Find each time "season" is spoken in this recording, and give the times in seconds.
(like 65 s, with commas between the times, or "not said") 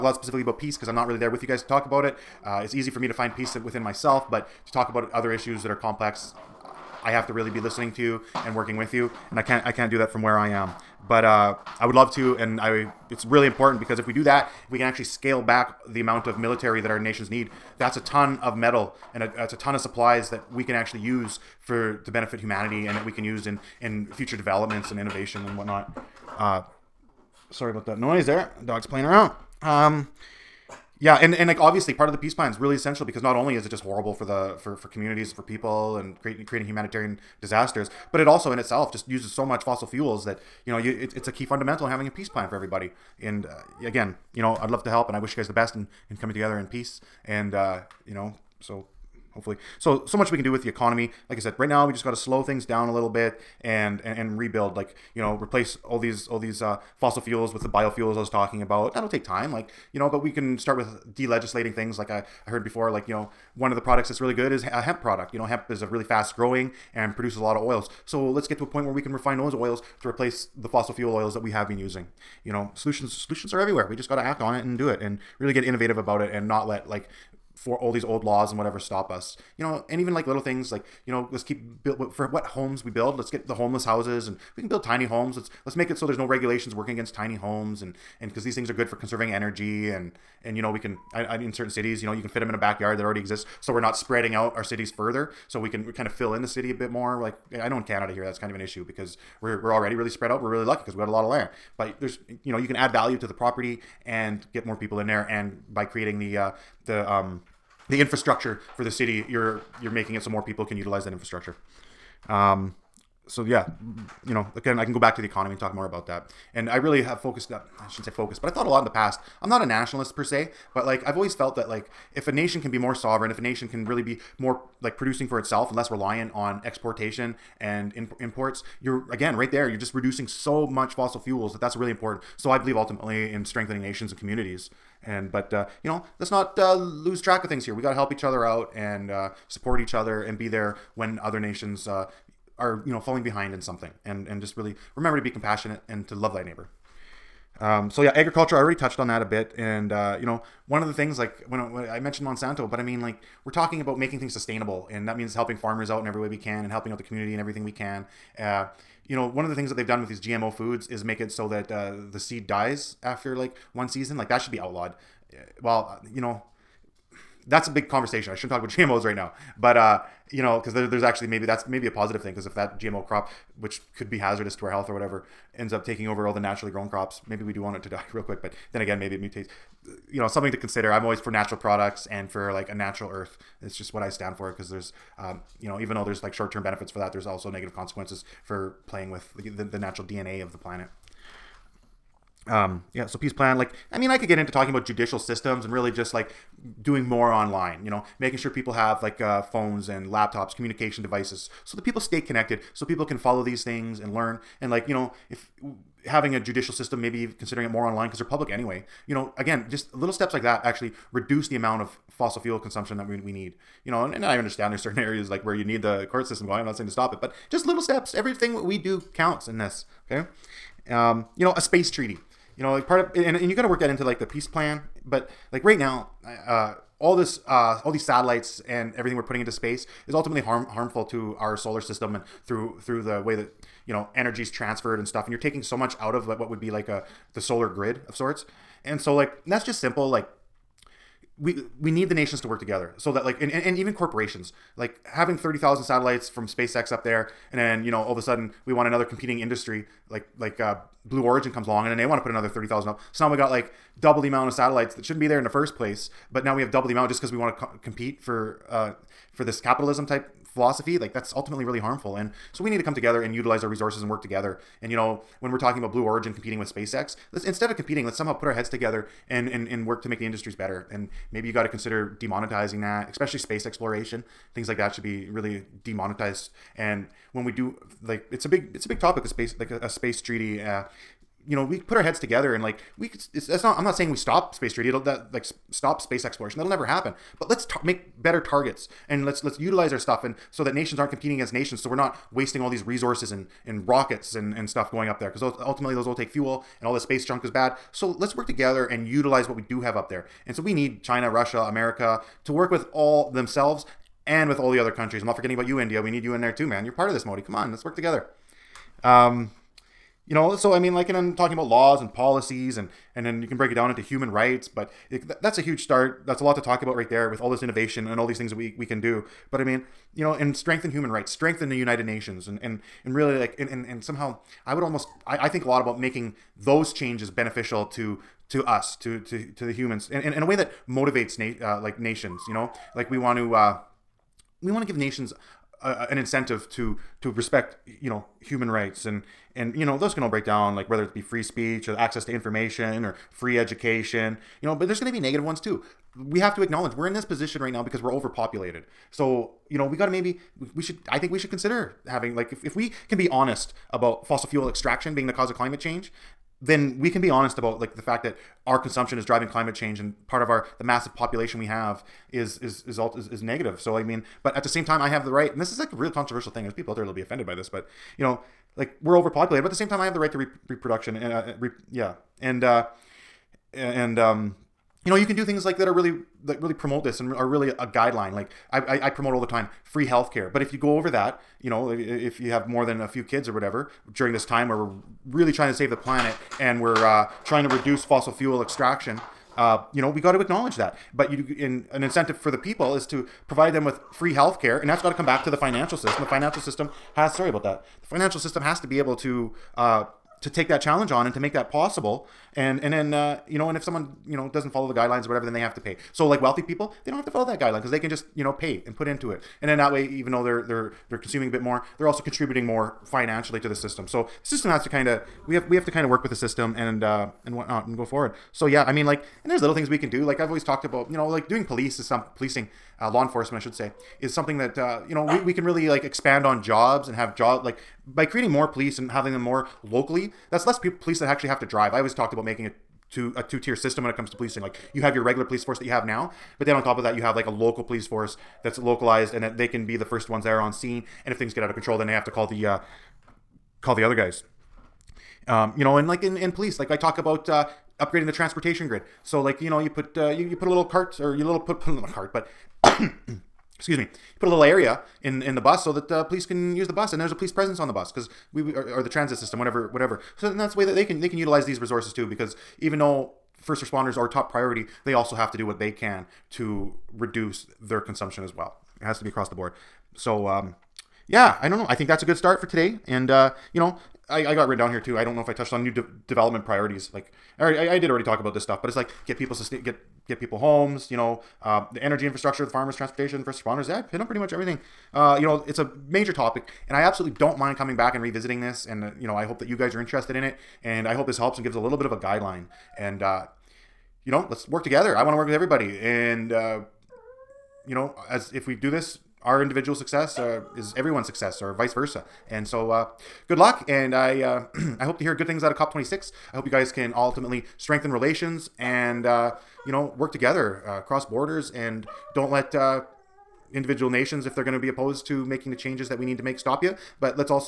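163 s.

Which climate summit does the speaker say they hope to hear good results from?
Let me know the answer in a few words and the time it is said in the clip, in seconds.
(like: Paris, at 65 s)
COP26, at 505 s.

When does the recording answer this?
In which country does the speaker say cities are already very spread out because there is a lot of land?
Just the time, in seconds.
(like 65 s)
97 s.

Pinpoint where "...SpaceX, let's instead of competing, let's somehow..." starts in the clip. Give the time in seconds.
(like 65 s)
266 s.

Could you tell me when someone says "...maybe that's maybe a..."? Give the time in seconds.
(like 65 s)
171 s.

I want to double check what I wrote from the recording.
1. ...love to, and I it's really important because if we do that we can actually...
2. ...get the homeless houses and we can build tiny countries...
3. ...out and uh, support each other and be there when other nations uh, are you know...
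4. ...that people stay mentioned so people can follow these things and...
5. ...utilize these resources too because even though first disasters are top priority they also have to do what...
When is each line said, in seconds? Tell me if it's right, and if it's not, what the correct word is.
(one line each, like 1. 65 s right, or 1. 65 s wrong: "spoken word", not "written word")
1. 11 s right
2. 83 s wrong: "homes", not "countries"
3. 138 s right
4. 201 s wrong: "connected", not "mentioned"
5. 461 s wrong: "responders", not "disasters".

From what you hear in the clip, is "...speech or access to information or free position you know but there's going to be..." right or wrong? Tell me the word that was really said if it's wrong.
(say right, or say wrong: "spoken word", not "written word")
wrong: "education", not "position".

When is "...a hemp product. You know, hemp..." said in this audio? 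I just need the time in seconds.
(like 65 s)
64 s.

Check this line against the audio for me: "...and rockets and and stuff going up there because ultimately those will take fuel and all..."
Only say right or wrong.
right.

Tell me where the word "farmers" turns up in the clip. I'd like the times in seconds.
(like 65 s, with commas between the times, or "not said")
155 s, 482 s.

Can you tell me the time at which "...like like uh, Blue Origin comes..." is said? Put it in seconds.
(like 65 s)
250 s.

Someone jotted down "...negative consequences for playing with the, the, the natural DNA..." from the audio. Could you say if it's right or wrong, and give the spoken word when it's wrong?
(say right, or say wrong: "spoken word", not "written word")
right.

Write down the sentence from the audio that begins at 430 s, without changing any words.
That's less pe- police that actually have to drive.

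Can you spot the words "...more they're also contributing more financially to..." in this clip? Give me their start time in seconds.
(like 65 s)
411 s.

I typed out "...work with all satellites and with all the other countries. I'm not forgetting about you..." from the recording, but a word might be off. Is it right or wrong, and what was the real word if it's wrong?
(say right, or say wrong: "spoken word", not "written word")
wrong: "themselves", not "satellites".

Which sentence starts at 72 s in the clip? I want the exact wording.
You know, solutions solutions are everywhere.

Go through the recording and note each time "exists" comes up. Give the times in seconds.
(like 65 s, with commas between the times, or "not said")
93 s.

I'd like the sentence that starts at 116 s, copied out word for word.
And I really have focused uh, I shouldn't say focused, but I thought a lot in the past.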